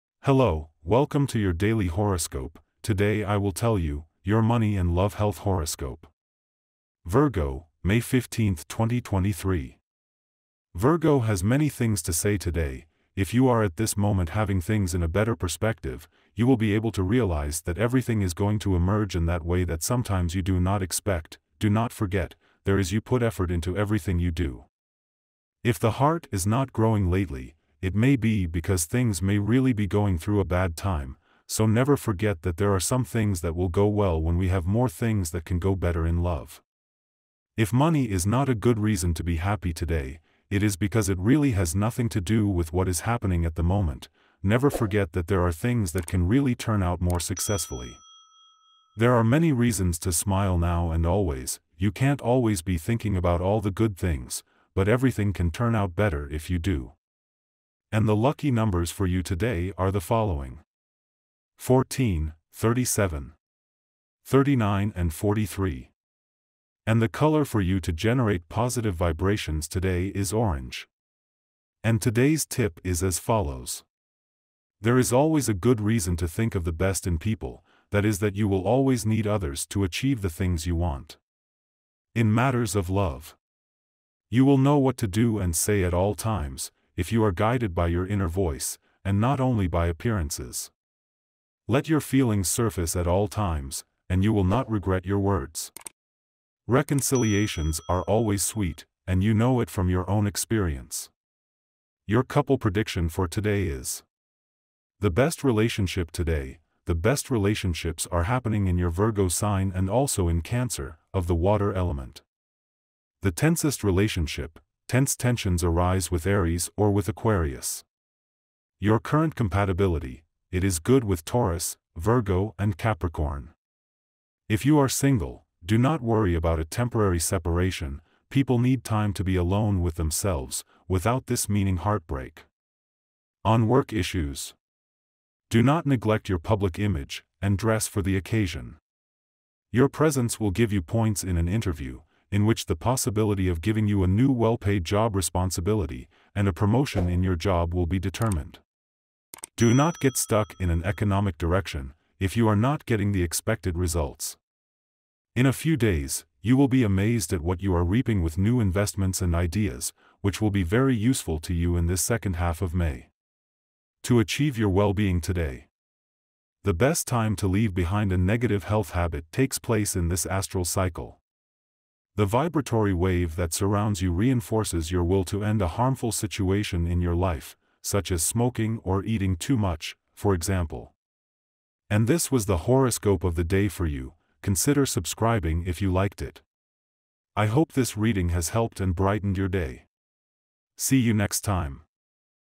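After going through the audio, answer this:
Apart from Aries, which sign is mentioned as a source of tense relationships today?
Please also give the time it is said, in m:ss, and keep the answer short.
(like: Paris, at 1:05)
Aquarius, at 1:57.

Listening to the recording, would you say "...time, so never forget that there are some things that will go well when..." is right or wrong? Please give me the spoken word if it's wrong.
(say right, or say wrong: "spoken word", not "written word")
right.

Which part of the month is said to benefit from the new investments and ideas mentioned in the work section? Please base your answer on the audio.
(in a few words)
Second half of May.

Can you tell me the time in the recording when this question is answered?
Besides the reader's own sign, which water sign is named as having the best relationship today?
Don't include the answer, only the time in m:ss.
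1:50.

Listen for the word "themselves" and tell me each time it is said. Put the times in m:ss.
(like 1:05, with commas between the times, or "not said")
2:09.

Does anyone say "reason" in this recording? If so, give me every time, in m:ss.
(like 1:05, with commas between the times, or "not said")
0:38, 0:49, 1:15.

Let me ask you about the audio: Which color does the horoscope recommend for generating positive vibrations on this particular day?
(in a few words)
Orange.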